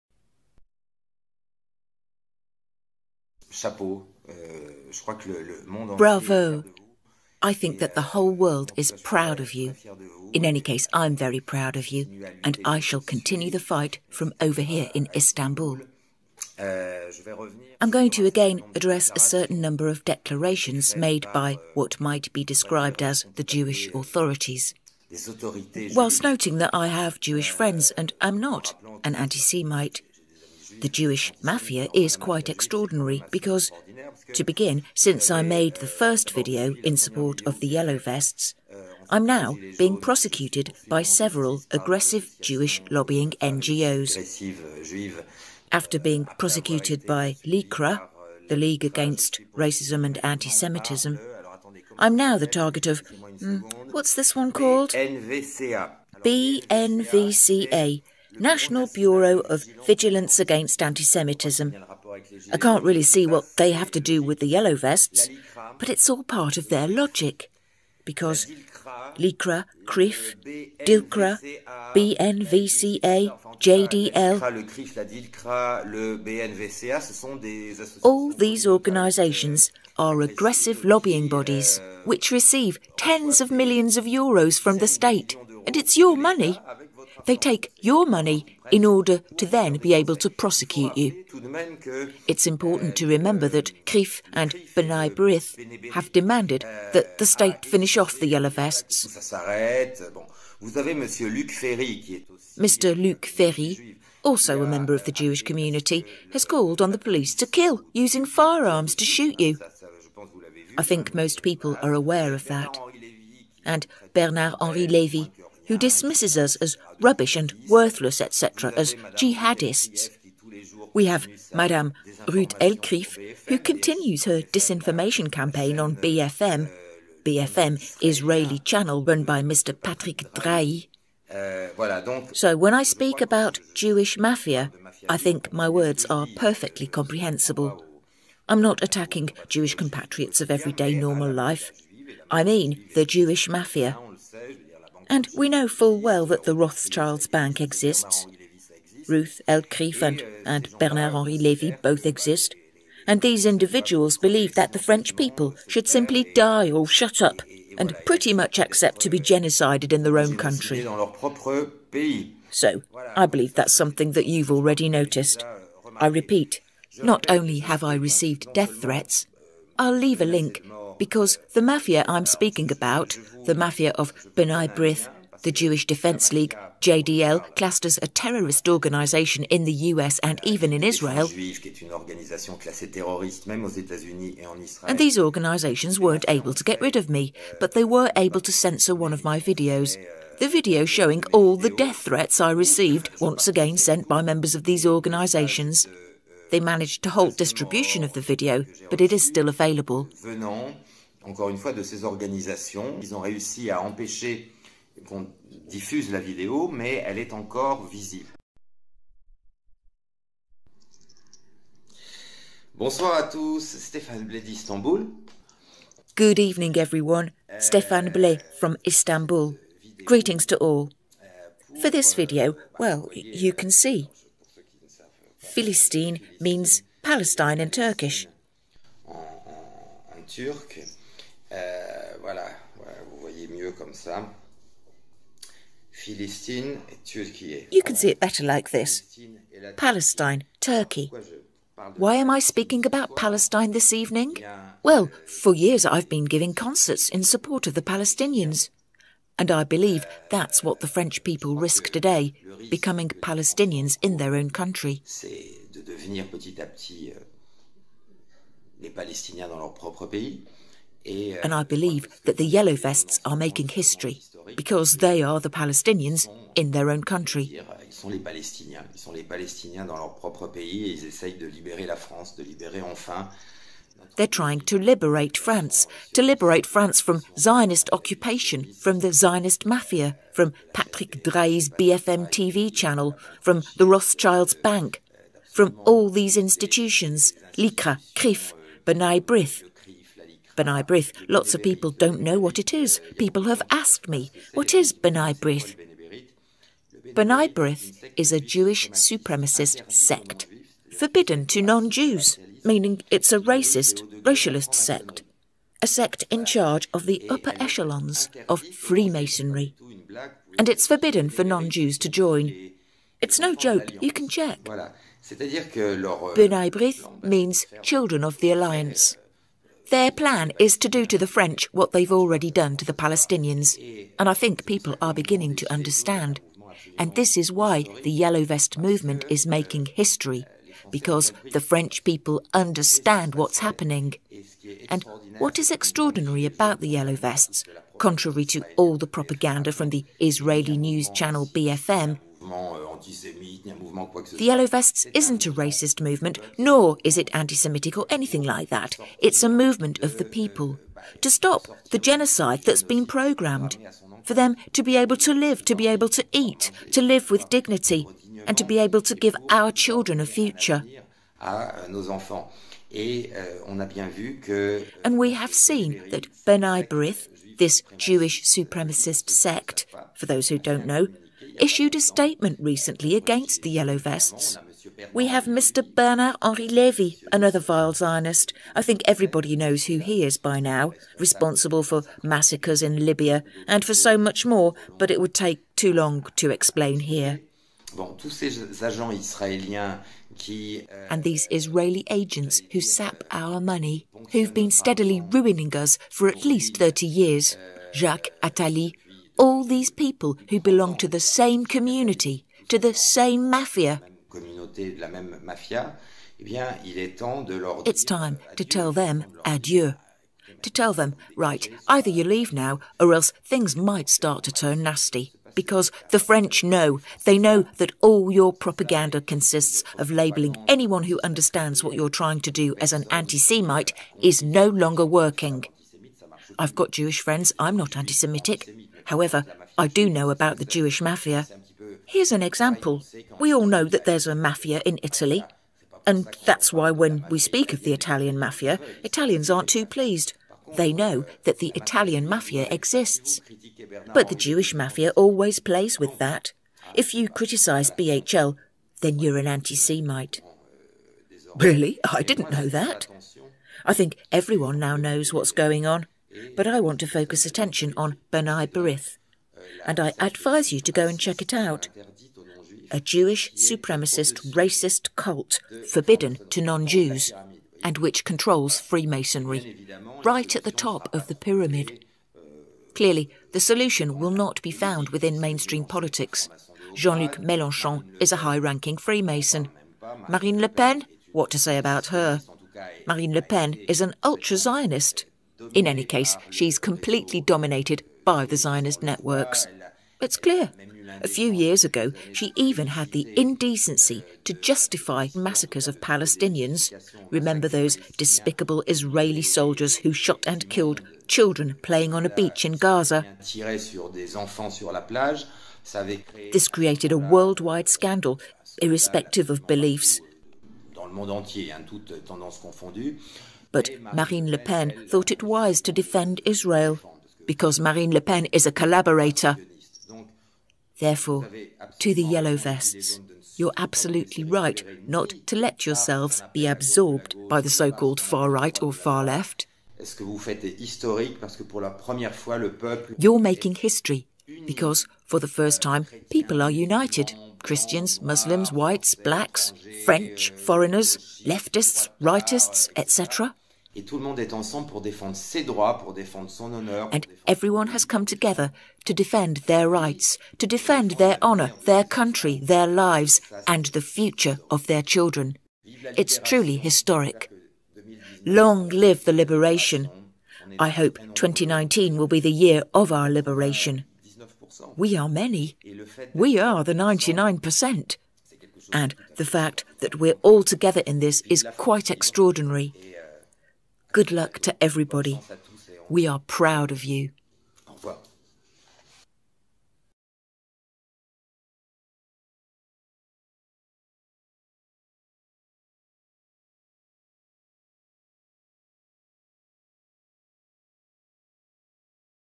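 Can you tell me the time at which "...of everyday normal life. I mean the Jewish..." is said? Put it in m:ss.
2:20.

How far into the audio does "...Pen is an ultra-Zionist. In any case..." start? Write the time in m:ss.
8:03.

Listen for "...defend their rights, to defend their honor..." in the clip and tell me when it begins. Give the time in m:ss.
9:09.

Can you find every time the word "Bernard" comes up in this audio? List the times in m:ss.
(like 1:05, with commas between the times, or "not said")
1:54, 2:30, 6:15.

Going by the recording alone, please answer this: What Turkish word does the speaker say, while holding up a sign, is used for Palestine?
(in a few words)
Philistine.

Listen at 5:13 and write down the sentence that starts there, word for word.
It's no joke, you can check.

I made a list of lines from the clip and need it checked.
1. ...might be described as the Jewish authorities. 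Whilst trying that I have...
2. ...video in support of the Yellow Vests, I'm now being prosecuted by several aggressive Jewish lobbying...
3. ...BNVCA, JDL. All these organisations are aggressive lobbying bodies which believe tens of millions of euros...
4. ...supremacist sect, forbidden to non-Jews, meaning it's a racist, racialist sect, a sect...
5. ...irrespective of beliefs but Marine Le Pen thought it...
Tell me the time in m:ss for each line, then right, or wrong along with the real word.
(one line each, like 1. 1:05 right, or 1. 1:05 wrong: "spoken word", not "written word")
1. 0:21 wrong: "noting", not "trying"
2. 0:36 right
3. 1:11 wrong: "receive", not "believe"
4. 4:58 right
5. 8:28 right.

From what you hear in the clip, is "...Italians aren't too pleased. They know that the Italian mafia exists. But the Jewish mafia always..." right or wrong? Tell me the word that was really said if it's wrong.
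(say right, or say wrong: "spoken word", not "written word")
right.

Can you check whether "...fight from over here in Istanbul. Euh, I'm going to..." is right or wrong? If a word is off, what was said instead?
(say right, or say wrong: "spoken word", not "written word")
right.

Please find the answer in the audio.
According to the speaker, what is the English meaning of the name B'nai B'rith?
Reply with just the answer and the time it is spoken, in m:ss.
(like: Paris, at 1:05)
Children of the Alliance, at 5:17.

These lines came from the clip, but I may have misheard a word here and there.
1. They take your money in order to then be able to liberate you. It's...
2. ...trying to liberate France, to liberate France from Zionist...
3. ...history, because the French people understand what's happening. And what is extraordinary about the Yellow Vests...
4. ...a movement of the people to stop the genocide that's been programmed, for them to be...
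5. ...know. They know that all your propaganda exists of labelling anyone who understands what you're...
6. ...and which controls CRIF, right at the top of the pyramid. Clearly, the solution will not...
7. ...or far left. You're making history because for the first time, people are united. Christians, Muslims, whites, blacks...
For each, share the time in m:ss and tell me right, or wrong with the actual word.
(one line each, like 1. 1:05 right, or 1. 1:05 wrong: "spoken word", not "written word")
1. 1:27 wrong: "prosecute", not "liberate"
2. 4:34 right
3. 5:29 right
4. 5:49 right
5. 6:56 wrong: "consists", not "exists"
6. 7:47 wrong: "Freemasonry", not "CRIF"
7. 8:48 right.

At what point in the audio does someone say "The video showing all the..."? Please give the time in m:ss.
3:10.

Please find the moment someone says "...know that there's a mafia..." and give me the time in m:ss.
7:13.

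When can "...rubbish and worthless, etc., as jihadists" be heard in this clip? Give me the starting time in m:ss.
1:56.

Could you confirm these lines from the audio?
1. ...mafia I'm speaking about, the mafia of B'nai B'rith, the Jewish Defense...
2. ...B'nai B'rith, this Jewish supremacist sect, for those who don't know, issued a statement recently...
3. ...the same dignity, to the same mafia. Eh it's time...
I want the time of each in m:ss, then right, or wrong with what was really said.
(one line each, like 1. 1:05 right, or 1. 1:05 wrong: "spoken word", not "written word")
1. 2:51 right
2. 6:06 right
3. 6:41 wrong: "community", not "dignity".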